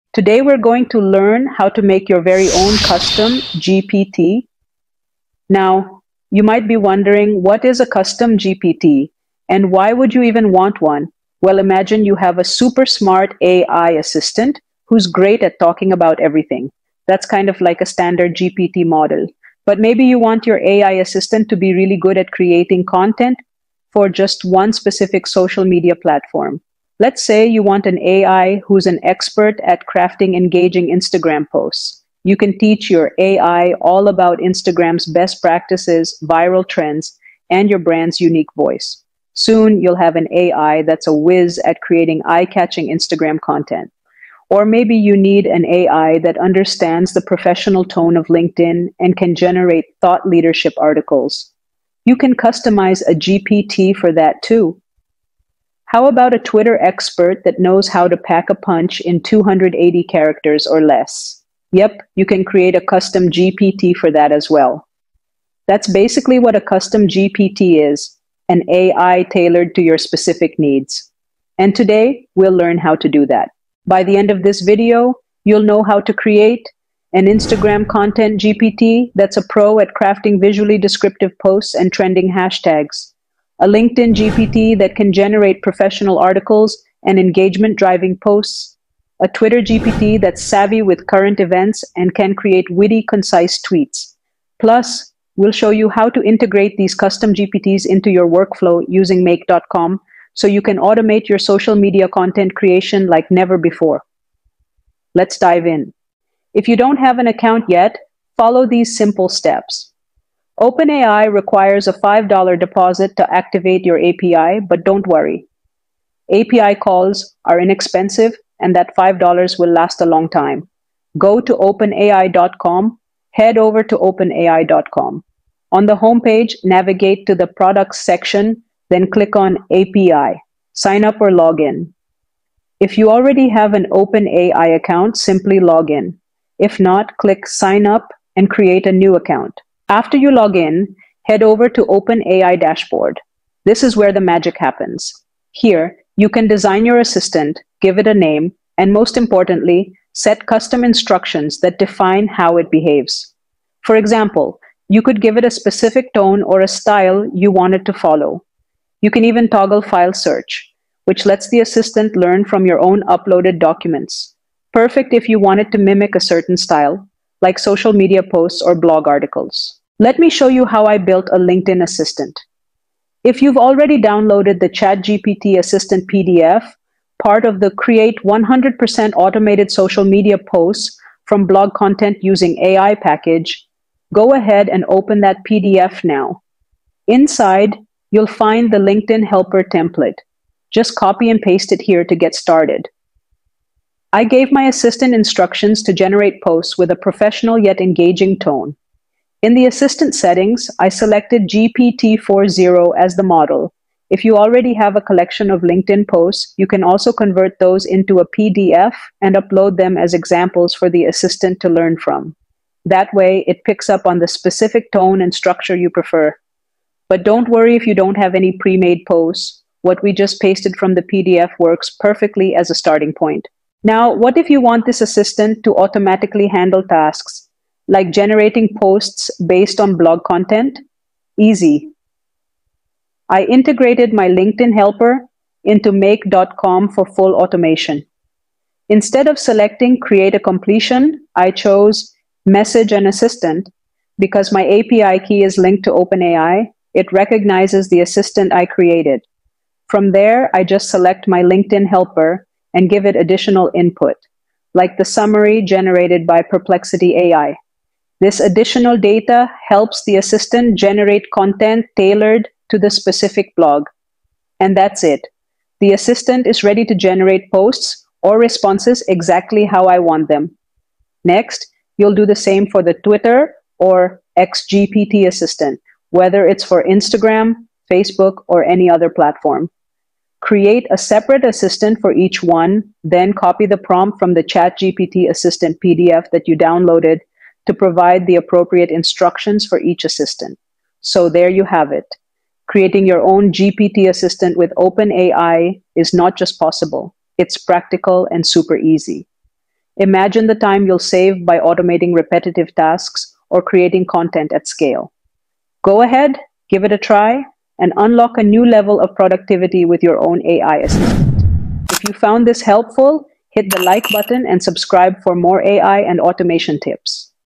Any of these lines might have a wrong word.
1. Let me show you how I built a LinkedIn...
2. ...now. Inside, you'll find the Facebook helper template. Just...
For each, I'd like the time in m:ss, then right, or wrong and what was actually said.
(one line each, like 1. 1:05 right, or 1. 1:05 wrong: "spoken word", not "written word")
1. 2:50 right
2. 3:06 wrong: "LinkedIn", not "Facebook".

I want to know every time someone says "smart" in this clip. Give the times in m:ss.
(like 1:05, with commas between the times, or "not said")
0:12.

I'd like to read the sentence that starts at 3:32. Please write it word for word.
That way, it picks up on the specific tone and structure you prefer.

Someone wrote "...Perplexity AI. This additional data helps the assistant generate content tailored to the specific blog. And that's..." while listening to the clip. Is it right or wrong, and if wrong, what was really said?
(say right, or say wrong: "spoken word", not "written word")
right.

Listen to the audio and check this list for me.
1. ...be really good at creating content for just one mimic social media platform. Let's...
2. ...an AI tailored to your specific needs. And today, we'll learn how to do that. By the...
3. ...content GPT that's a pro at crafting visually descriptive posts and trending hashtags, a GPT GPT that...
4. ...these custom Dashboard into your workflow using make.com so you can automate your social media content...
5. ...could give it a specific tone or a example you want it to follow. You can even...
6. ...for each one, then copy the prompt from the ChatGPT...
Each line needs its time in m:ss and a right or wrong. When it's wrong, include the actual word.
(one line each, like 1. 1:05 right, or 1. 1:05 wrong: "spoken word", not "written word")
1. 0:21 wrong: "specific", not "mimic"
2. 1:08 right
3. 1:17 wrong: "LinkedIn", not "GPT"
4. 1:36 wrong: "GPTs", not "Dashboard"
5. 2:35 wrong: "style", not "example"
6. 4:41 right.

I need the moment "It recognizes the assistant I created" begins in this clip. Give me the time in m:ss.
4:06.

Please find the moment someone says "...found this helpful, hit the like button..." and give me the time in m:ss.
5:12.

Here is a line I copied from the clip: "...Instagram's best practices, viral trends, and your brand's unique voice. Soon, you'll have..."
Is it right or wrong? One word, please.
right.